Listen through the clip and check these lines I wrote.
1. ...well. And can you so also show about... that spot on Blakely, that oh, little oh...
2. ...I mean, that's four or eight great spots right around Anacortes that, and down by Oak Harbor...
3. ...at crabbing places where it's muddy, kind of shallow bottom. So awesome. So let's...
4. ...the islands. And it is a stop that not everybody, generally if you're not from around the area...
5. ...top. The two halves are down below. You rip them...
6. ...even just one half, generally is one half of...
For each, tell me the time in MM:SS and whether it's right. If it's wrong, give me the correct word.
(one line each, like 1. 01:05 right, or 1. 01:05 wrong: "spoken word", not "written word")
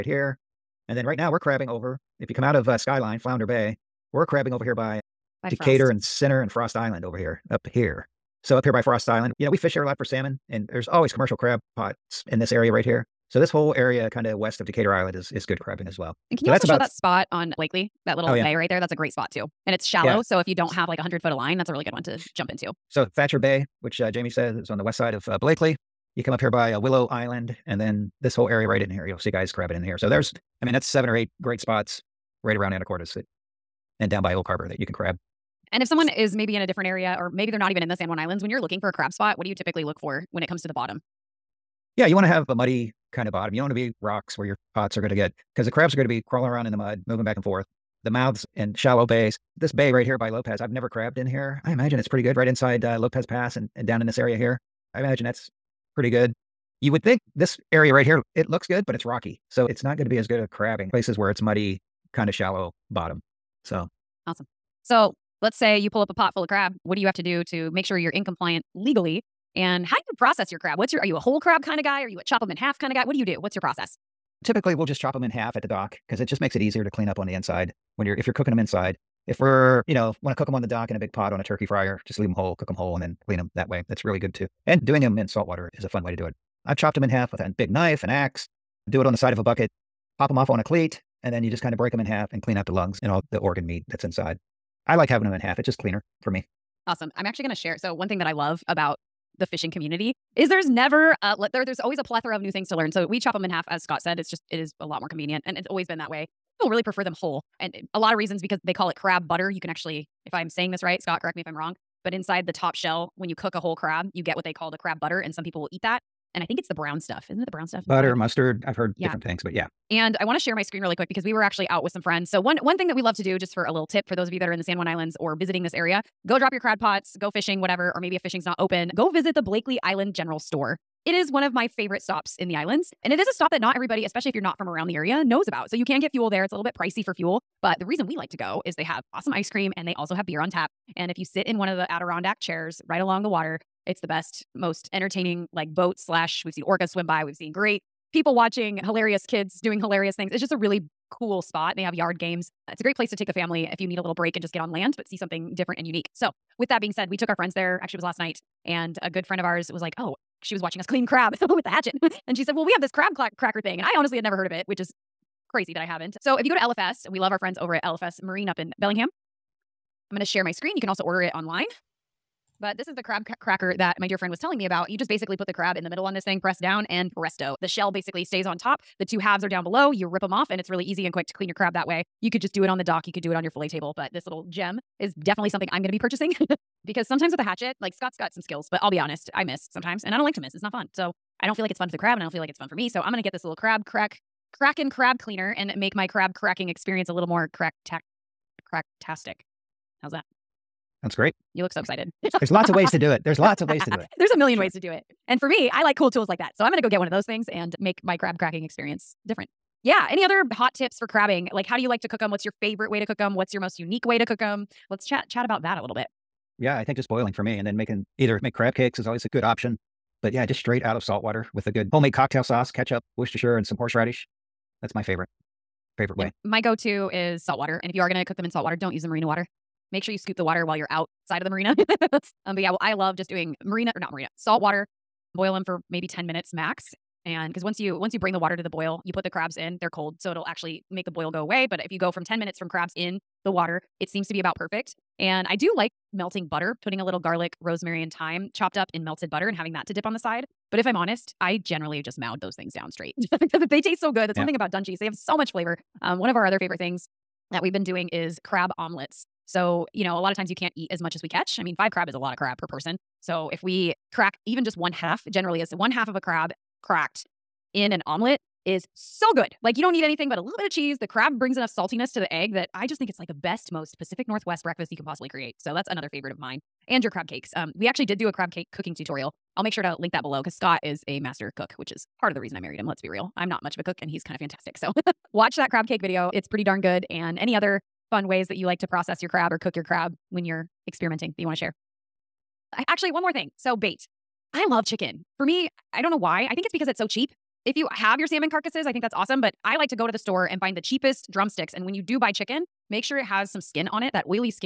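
1. 00:15 right
2. 00:30 wrong: "seven", not "four"
3. 01:00 right
4. 02:12 wrong: "especially", not "generally"
5. 02:58 right
6. 04:24 right.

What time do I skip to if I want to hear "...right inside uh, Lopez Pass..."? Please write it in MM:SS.
00:52.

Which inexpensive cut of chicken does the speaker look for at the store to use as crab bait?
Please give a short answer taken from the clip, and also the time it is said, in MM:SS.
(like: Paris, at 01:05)
Drumsticks, at 05:01.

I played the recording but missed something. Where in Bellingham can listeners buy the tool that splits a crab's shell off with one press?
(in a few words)
LFS Marine.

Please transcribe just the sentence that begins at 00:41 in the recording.
Yeah, you want to have a muddy kind of bottom.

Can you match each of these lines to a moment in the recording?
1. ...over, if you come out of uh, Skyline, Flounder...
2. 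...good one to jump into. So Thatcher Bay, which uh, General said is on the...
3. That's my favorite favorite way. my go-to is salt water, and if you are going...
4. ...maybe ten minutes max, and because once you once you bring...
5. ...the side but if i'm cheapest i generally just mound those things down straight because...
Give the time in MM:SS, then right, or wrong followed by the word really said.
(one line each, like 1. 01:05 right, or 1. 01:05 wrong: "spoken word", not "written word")
1. 00:01 right
2. 00:21 wrong: "Jamie", not "General"
3. 03:44 right
4. 03:55 right
5. 04:10 wrong: "honest", not "cheapest".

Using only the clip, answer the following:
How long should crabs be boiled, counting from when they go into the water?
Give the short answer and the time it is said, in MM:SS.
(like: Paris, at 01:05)
10 minutes, at 04:02.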